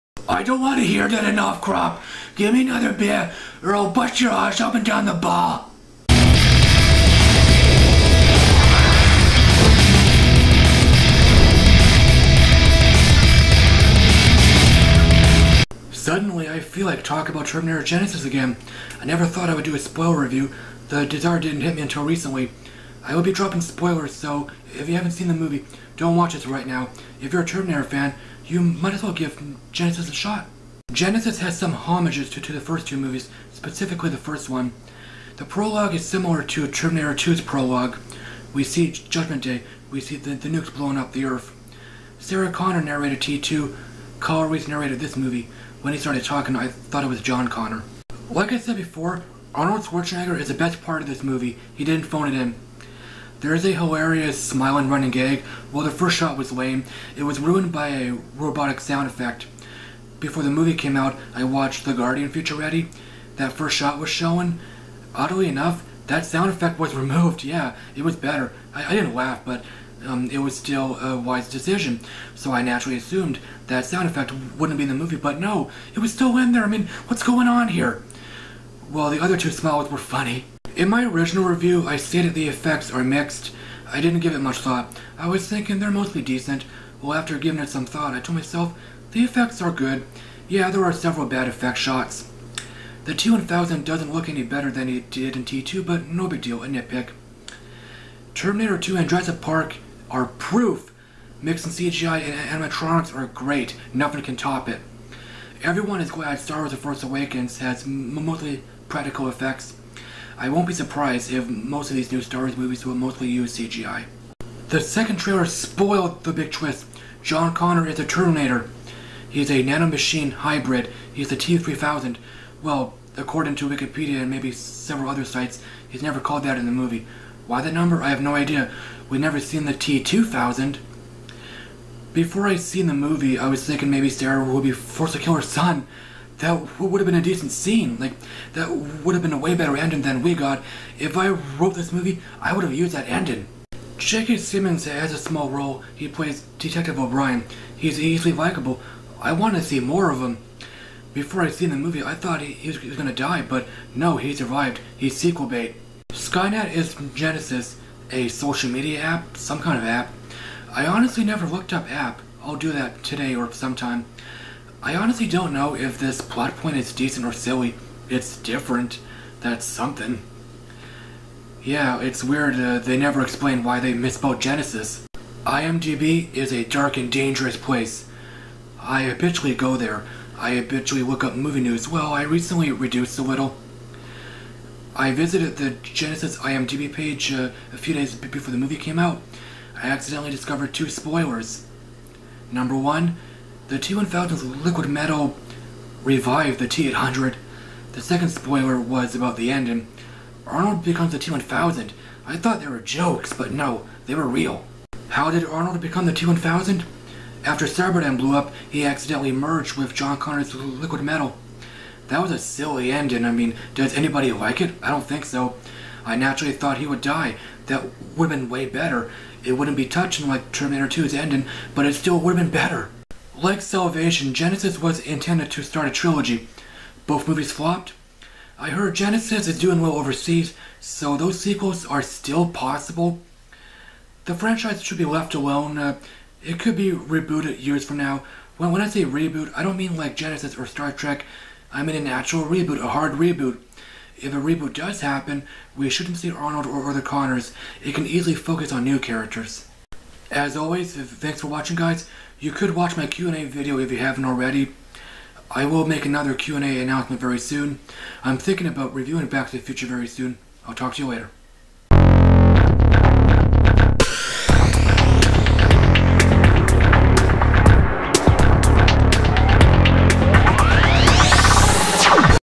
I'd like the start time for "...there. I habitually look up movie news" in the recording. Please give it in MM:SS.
02:59.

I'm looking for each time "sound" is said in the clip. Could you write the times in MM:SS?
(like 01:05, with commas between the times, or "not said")
00:58, 01:06, 01:13.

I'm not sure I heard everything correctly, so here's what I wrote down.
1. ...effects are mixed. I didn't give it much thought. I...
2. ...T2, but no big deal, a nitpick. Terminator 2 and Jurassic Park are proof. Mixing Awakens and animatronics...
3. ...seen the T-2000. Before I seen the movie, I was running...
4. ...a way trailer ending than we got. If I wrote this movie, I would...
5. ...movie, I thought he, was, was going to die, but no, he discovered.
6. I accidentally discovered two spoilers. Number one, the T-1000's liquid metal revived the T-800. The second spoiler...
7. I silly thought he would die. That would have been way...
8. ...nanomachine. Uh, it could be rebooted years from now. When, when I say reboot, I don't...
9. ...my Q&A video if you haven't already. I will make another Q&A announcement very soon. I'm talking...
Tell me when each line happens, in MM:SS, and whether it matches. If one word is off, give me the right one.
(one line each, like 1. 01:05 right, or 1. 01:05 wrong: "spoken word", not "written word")
1. 01:22 right
2. 01:35 wrong: "CGI", not "Awakens"
3. 02:09 wrong: "thinking", not "running"
4. 02:19 wrong: "better", not "trailer"
5. 02:31 wrong: "survived", not "discovered"
6. 03:09 right
7. 03:36 wrong: "naturally", not "silly"
8. 03:55 wrong: "alone", not "nanomachine"
9. 04:12 wrong: "thinking", not "talking".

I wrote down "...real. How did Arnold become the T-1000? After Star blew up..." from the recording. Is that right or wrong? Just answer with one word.
wrong.